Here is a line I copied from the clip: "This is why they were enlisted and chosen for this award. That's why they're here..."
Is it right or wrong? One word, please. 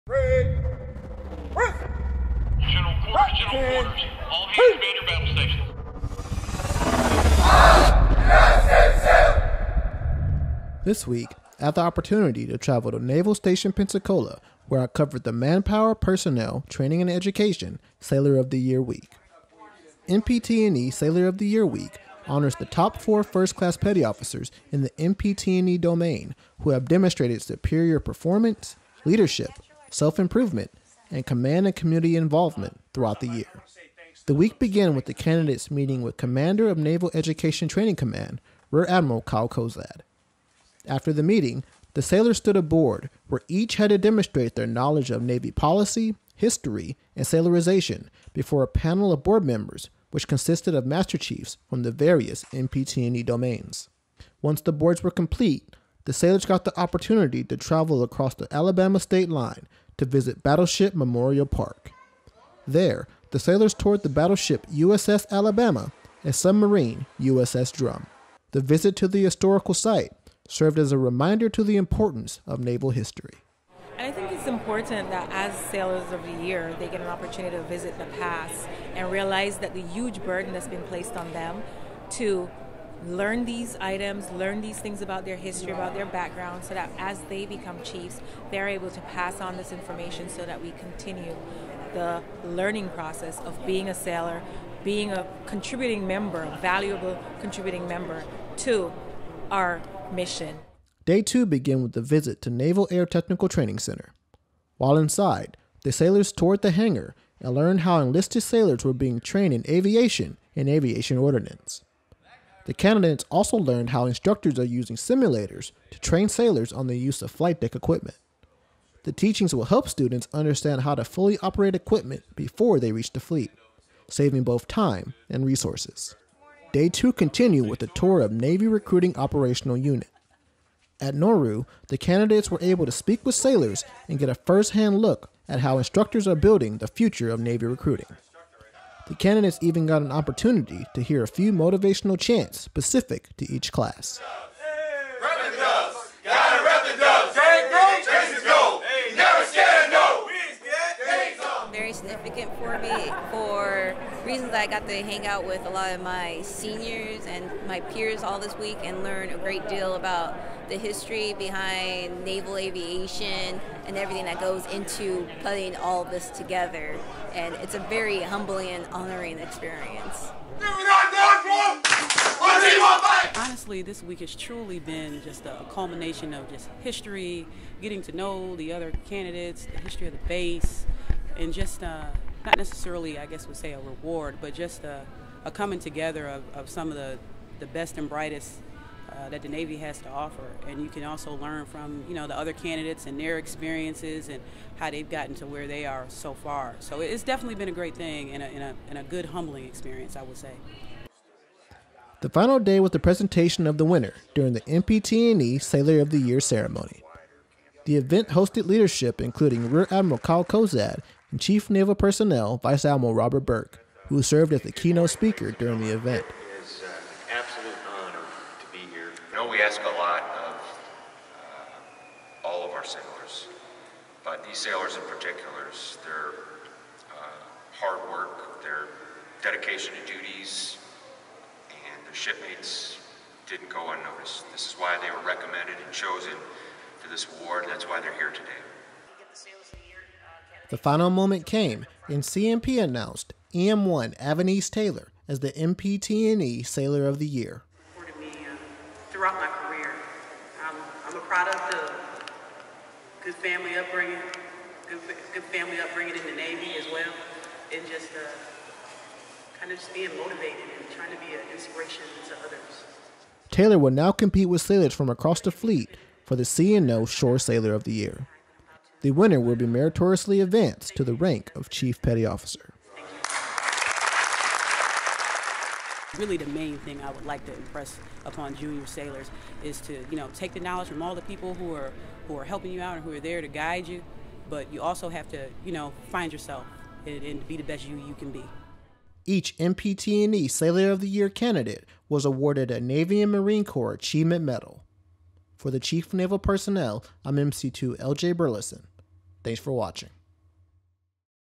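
wrong.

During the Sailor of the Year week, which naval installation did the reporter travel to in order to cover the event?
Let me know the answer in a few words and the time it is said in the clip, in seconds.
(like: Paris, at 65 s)
Naval Station Pensacola, at 13 s.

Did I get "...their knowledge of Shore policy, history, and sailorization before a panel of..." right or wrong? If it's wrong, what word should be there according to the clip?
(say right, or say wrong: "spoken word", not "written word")
wrong: "Navy", not "Shore".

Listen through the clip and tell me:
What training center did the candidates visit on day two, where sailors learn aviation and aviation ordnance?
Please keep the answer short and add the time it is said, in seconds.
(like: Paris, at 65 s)
Naval Air Technical Training Center, at 102 s.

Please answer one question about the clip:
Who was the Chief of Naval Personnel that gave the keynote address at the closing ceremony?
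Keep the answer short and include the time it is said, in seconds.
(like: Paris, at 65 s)
Vice Admiral Robert Burke, at 212 s.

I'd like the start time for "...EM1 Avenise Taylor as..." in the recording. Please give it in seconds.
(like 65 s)
243 s.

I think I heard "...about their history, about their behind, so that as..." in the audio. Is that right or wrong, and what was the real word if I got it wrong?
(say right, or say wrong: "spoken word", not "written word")
wrong: "background", not "behind".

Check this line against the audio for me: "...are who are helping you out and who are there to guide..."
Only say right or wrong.
right.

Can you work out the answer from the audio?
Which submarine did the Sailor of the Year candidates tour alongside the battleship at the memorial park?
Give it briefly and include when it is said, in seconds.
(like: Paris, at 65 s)
USS Drum, at 67 s.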